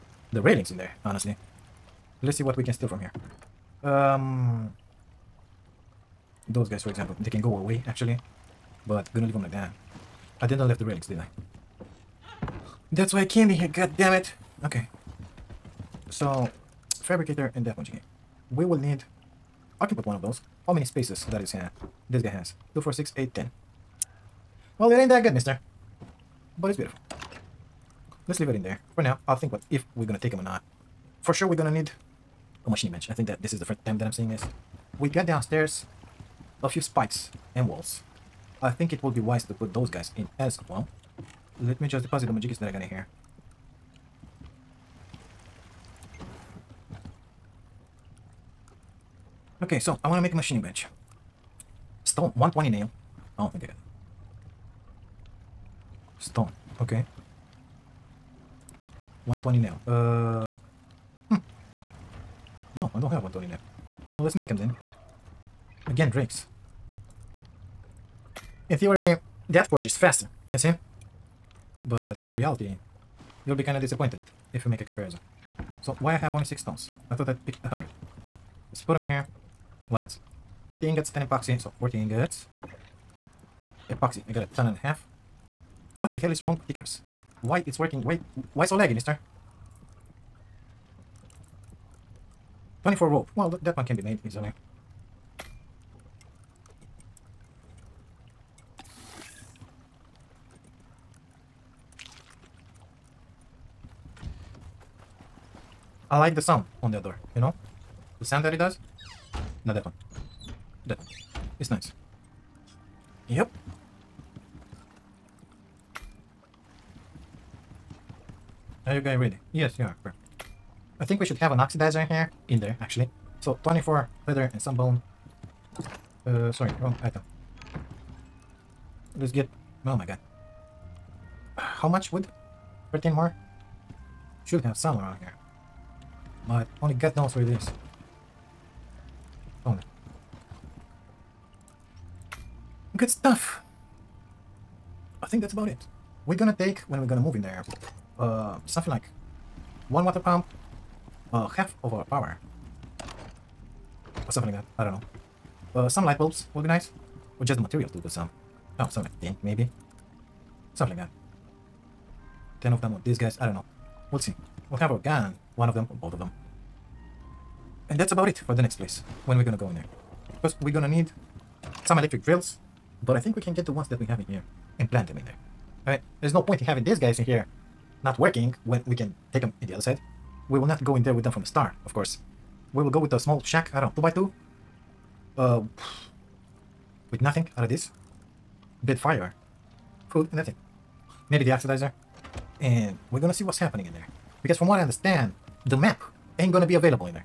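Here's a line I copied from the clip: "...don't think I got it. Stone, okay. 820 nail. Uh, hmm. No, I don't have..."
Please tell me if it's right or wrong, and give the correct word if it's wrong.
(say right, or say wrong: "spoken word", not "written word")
wrong: "120", not "820".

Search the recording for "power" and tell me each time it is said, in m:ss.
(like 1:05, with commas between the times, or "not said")
2:32.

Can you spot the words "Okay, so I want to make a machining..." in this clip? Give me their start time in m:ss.
0:49.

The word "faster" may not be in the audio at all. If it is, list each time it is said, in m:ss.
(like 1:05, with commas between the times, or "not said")
1:09.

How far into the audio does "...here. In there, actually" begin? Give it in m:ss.
2:02.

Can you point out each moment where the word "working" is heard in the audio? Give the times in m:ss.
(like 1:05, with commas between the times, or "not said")
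1:27, 2:58.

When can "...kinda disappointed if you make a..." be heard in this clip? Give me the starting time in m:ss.
1:13.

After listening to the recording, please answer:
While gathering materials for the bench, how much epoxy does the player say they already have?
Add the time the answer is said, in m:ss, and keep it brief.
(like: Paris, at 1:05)
a ton and a half, at 1:24.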